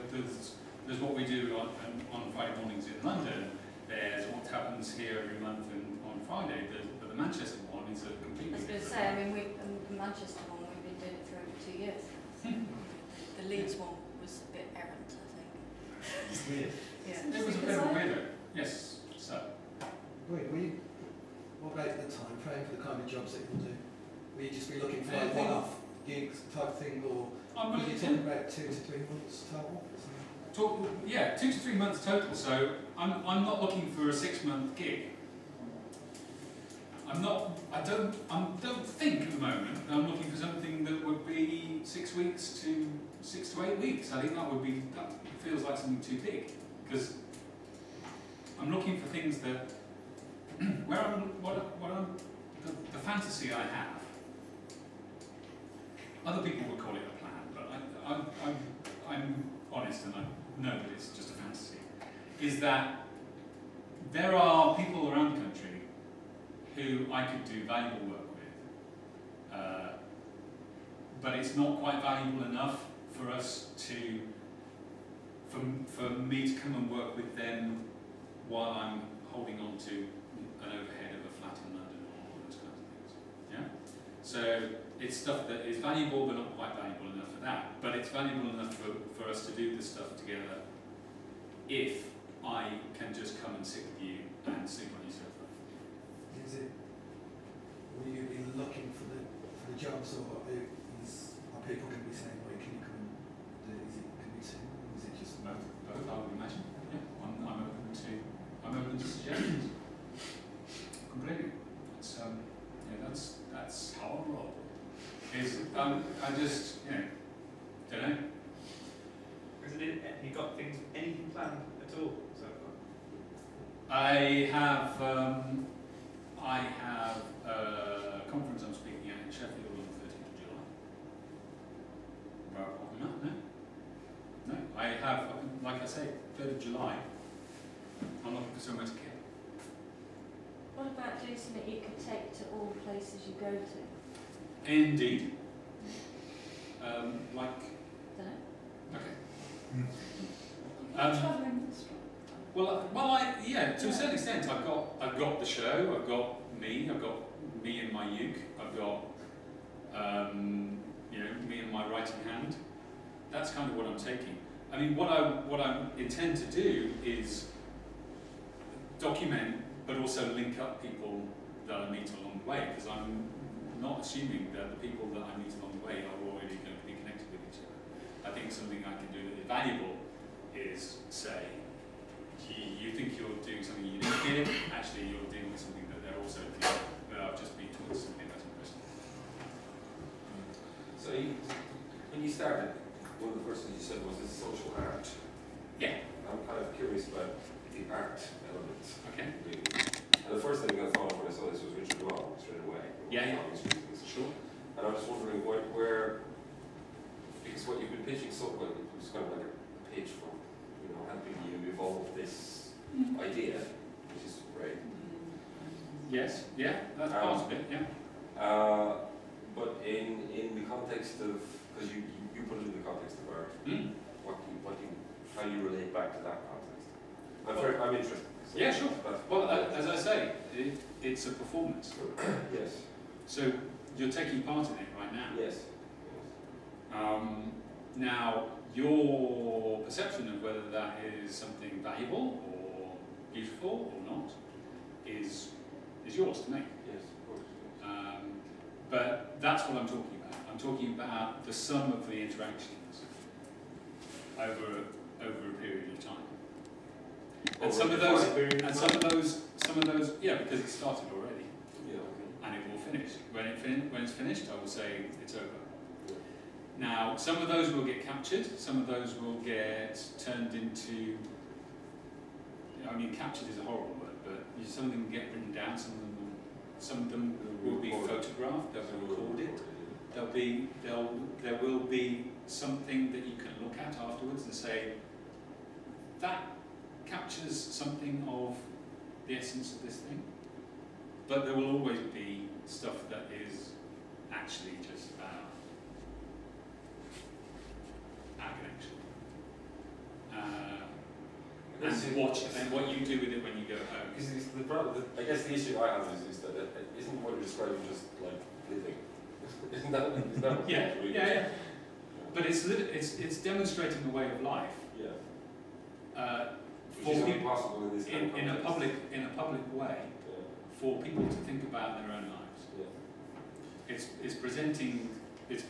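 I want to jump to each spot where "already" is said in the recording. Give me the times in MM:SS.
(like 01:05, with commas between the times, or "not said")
02:56, 04:21.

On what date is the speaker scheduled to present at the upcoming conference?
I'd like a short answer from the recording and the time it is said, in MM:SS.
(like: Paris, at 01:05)
13th of July, at 02:10.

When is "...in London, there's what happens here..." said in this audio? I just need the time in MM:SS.
00:02.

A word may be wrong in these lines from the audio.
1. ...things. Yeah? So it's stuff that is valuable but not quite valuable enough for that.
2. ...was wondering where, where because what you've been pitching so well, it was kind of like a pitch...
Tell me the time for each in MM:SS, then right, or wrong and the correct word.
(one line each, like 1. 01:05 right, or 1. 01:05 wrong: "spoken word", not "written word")
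1. 01:23 right
2. 03:24 right.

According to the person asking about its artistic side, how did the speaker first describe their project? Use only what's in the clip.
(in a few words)
social art.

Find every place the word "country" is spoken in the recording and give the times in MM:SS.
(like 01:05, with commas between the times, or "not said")
01:05.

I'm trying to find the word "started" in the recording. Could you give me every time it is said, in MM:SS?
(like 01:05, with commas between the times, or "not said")
03:12, 04:20.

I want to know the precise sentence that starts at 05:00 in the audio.
Uh, and watch and what you do with it when you go home.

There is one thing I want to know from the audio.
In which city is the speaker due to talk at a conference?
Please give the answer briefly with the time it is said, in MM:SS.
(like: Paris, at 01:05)
Sheffield, at 02:09.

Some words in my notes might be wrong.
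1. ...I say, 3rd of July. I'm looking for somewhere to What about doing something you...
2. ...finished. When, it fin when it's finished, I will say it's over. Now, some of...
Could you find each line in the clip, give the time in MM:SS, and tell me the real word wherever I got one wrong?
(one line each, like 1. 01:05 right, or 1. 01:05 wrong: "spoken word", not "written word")
1. 02:15 right
2. 04:22 right.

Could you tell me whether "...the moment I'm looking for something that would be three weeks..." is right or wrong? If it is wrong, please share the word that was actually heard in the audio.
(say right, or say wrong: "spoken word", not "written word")
wrong: "six", not "three".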